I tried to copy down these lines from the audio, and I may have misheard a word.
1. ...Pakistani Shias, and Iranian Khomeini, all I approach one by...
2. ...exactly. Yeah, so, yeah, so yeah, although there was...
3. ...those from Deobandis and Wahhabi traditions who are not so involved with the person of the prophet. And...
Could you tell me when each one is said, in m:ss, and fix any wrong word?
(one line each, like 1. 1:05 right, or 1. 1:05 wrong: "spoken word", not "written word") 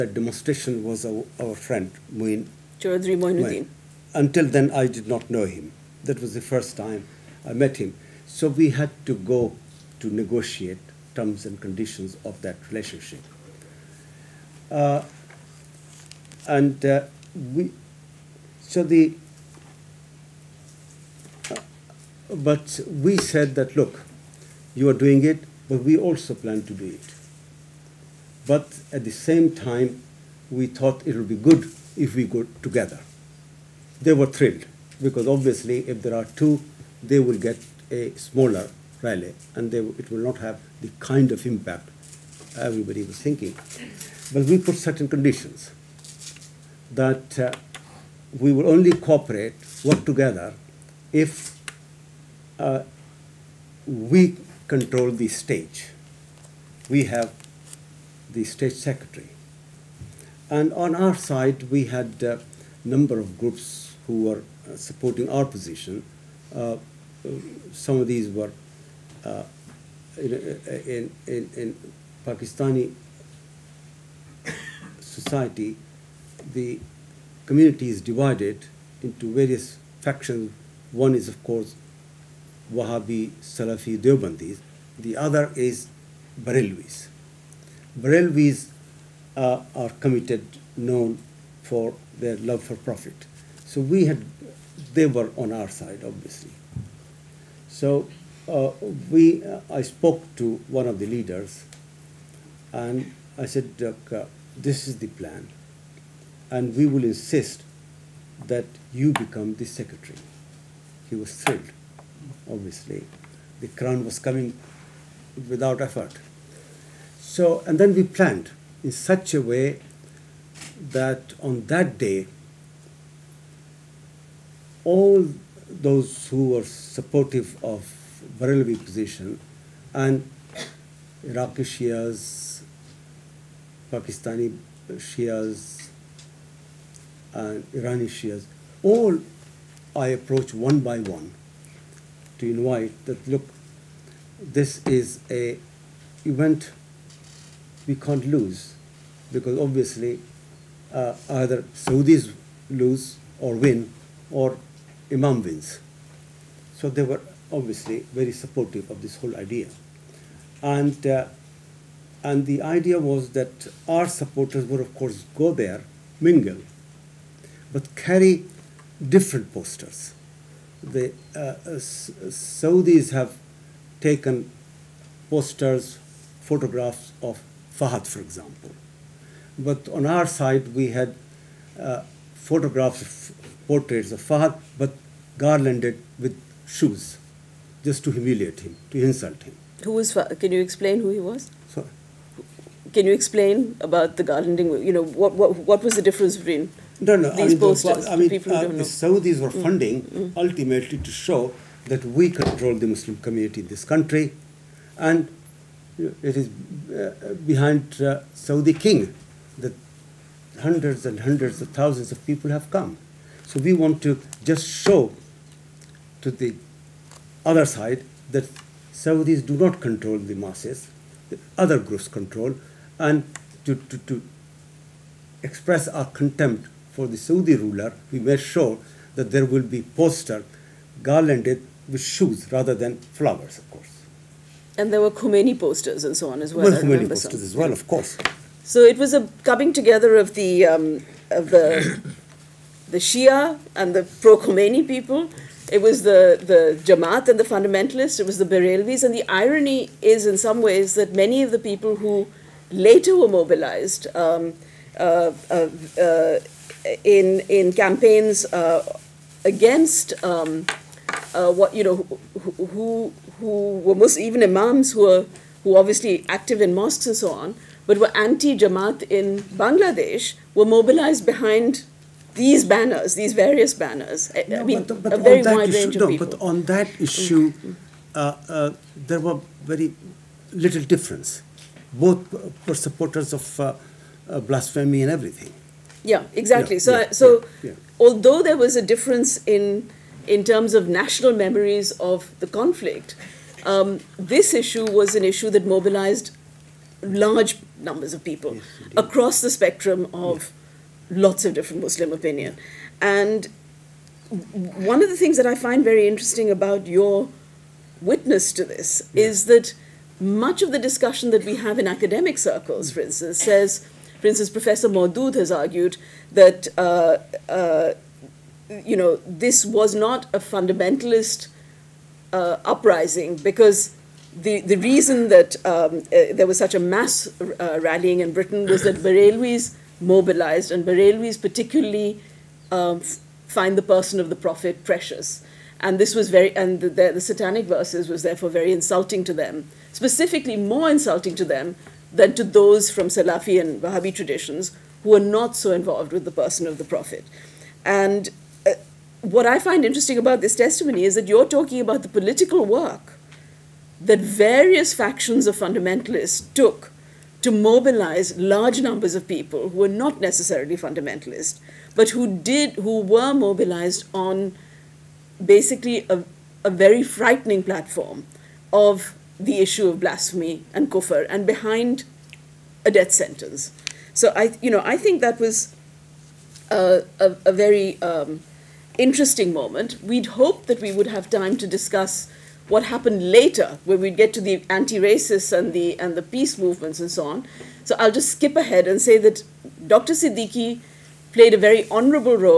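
1. 2:13 wrong: "Shias", not "Khomeini"
2. 4:46 right
3. 5:42 wrong: "Salafi", not "Deobandis".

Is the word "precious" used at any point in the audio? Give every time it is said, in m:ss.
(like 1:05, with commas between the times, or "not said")
5:34.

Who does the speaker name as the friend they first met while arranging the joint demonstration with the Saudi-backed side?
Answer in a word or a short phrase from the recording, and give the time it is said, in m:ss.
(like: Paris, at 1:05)
Muin Chaudhry Moinuddin, at 0:02.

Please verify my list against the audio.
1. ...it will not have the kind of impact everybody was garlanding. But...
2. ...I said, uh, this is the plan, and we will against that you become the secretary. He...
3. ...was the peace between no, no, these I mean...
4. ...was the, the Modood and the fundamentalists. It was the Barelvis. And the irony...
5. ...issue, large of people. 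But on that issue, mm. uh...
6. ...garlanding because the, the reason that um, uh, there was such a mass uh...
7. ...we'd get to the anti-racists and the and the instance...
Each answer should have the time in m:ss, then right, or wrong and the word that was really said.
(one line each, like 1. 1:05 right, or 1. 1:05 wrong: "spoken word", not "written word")
1. 0:39 wrong: "thinking", not "garlanding"
2. 1:43 wrong: "insist", not "against"
3. 3:15 wrong: "difference", not "peace"
4. 4:05 wrong: "Jamaat", not "Modood"
5. 4:35 wrong: "range", not "large"
6. 5:22 wrong: "uprising", not "garlanding"
7. 6:23 wrong: "peace", not "instance".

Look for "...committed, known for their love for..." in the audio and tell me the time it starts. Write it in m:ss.
1:30.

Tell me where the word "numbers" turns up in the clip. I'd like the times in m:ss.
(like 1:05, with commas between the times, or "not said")
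1:02, 4:57, 5:58.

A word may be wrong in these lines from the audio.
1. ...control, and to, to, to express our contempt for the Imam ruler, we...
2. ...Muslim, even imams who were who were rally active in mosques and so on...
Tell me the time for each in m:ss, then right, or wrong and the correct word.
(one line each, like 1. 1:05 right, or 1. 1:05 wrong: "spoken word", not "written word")
1. 3:42 wrong: "Saudi", not "Imam"
2. 4:23 wrong: "obviously", not "rally".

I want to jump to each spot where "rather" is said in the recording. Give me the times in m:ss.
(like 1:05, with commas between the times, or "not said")
3:52.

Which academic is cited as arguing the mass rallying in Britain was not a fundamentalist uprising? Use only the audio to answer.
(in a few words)
Professor Modood.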